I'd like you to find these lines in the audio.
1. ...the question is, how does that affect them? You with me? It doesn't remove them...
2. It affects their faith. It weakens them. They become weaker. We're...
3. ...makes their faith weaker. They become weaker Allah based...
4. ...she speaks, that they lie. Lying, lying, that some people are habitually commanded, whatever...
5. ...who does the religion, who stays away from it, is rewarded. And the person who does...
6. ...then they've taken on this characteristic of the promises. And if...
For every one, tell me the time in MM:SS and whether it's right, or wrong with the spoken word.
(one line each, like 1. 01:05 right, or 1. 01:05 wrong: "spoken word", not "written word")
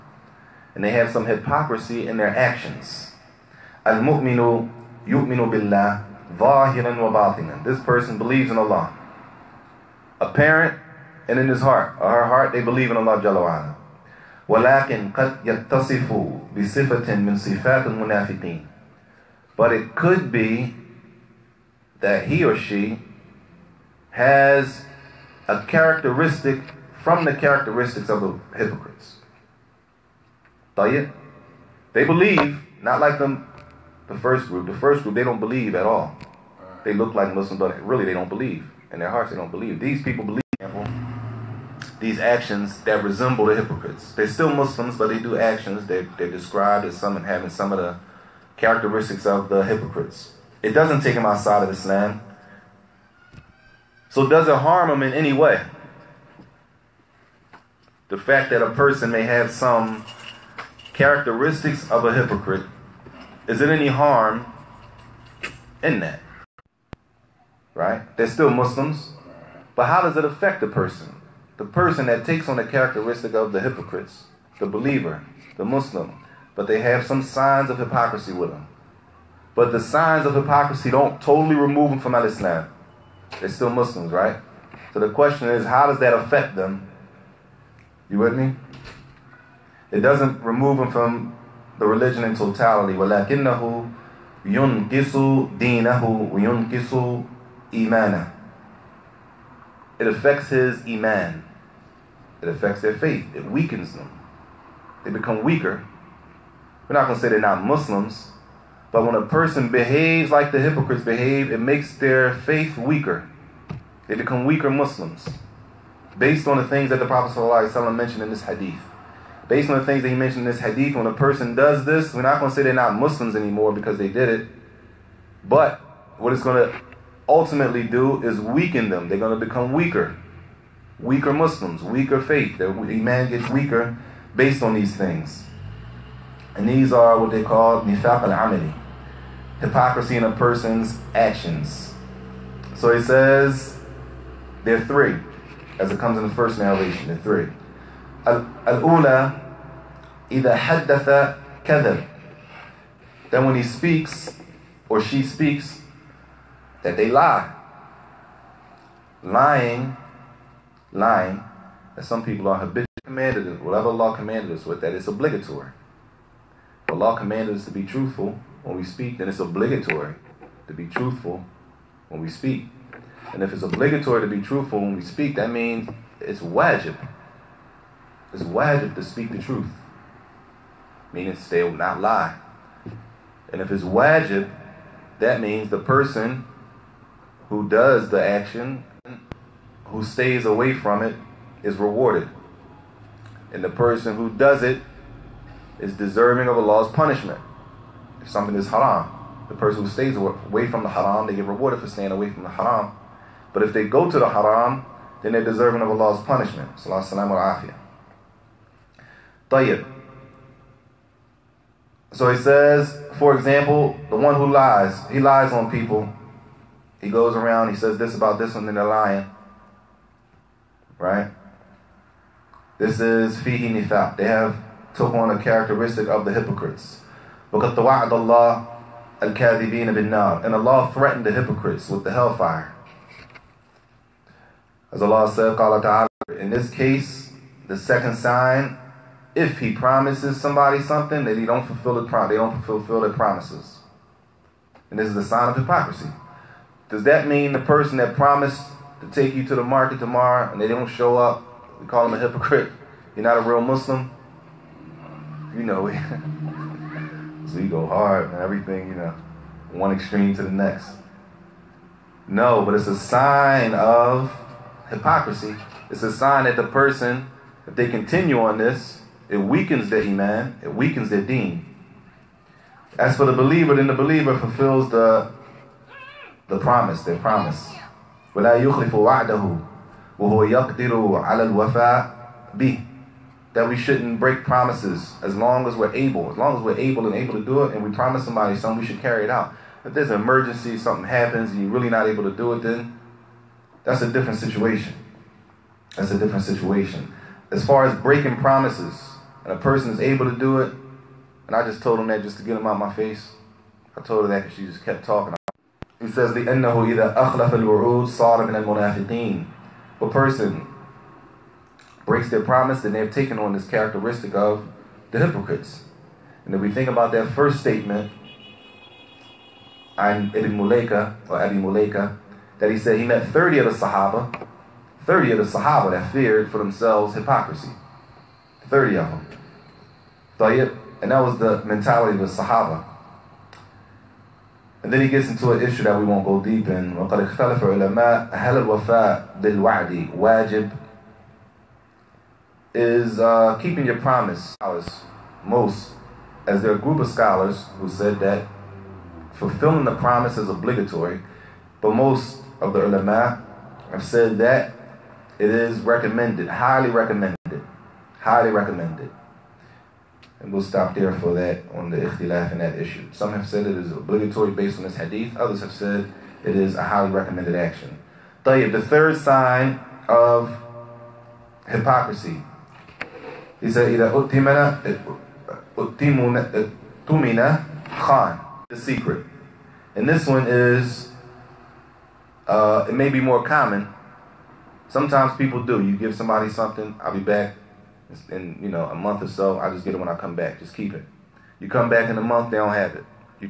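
1. 01:24 right
2. 01:42 right
3. 01:51 wrong: "Muslims", not "Allah"
4. 02:34 right
5. 03:07 wrong: "action", not "religion"
6. 05:12 wrong: "hypocrites", not "promises".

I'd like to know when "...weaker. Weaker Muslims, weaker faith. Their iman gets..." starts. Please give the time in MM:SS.
02:09.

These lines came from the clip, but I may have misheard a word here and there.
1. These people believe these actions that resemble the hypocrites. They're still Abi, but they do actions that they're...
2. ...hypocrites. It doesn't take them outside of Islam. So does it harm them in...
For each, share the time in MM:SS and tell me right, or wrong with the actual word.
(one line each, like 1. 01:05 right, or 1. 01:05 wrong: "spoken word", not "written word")
1. 00:39 wrong: "Muslims", not "Abi"
2. 00:49 right.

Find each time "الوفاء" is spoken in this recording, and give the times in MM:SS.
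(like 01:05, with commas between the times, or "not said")
04:41, 05:38.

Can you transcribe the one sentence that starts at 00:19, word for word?
But it could be that he or she has a characteristic from the characteristics of the hypocrites.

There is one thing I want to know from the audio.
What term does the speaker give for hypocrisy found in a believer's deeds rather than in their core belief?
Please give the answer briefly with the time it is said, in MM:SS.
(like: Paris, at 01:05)
nifaq al-amali, at 02:17.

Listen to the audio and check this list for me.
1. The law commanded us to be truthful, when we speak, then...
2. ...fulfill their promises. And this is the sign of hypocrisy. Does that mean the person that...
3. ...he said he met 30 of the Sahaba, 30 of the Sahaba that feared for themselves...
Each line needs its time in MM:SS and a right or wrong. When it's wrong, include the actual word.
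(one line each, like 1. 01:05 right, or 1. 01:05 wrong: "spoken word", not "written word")
1. 02:46 right
2. 04:02 right
3. 05:22 right.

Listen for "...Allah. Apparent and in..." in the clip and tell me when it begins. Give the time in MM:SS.
00:08.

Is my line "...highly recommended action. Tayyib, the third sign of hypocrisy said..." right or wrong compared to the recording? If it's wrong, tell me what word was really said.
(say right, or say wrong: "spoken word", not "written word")
right.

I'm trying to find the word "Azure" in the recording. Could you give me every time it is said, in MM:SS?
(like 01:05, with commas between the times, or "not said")
not said.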